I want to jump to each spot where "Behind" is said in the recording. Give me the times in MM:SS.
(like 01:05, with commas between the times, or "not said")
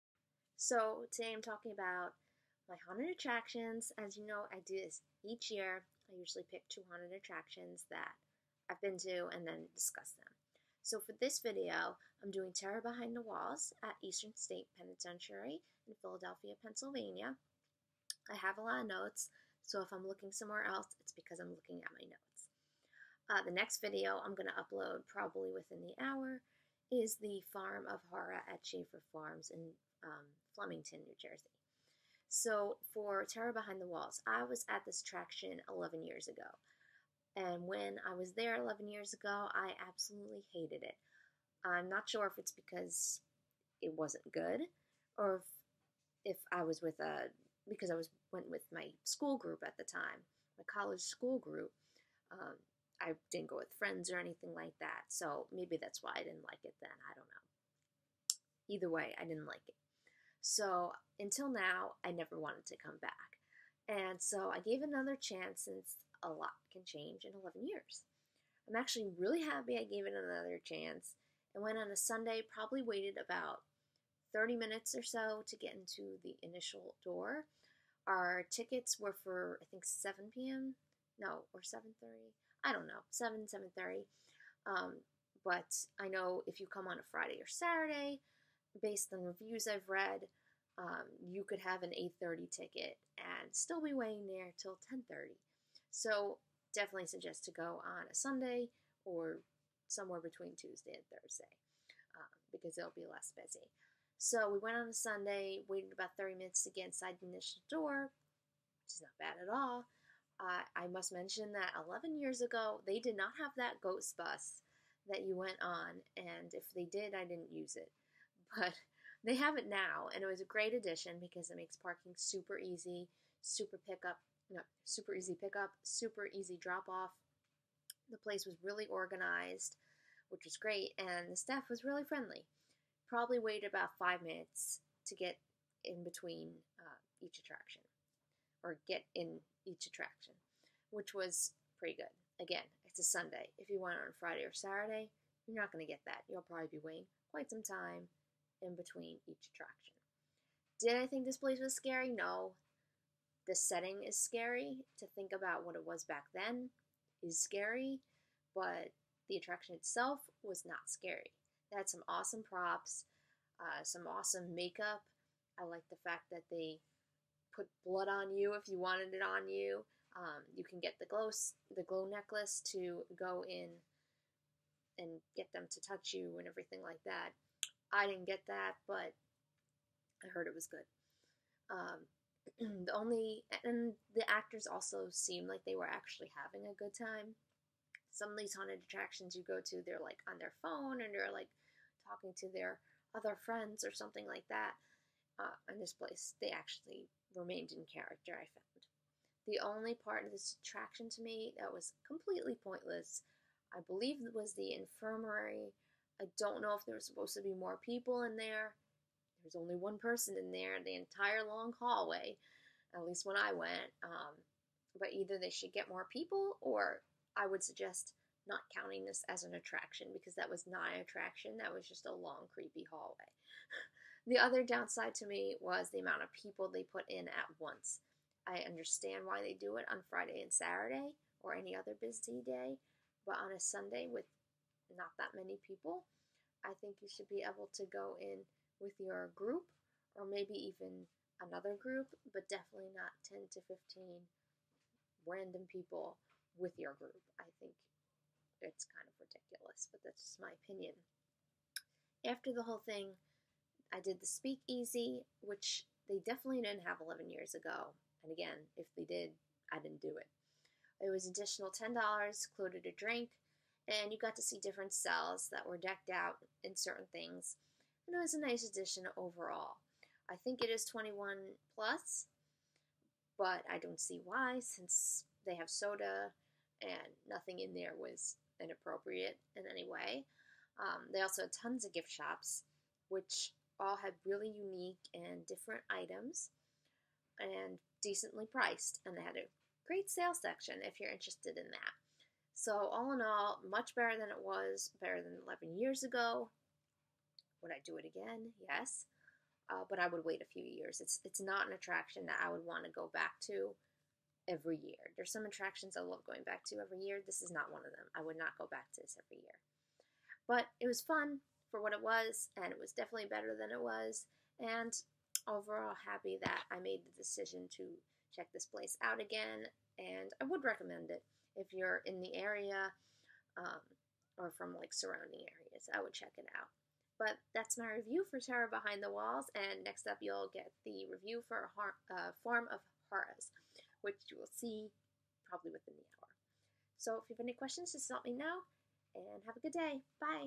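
00:12, 00:33, 05:28.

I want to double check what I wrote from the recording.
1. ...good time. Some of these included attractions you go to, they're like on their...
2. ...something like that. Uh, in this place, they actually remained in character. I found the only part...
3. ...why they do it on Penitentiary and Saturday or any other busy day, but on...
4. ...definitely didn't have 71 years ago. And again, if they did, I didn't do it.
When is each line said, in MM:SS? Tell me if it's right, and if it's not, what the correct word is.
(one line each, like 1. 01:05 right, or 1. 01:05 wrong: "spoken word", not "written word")
1. 03:06 wrong: "haunted", not "included"
2. 03:13 right
3. 03:49 wrong: "Friday", not "Penitentiary"
4. 04:16 wrong: "11", not "71".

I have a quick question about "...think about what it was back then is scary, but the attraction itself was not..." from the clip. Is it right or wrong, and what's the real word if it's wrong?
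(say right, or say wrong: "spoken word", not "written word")
right.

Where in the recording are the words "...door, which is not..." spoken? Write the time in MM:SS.
01:47.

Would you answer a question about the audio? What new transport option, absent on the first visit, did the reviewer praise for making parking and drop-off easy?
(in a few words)
ghost bus.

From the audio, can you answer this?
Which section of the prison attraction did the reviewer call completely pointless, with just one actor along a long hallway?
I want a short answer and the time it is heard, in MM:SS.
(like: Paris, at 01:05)
the infirmary, at 03:24.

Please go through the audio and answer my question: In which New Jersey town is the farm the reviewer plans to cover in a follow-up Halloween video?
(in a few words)
Flemington.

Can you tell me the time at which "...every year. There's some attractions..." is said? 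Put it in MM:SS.
05:04.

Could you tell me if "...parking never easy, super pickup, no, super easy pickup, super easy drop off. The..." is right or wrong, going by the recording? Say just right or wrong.
wrong.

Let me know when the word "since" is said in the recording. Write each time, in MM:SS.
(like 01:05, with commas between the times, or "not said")
01:05, 04:34.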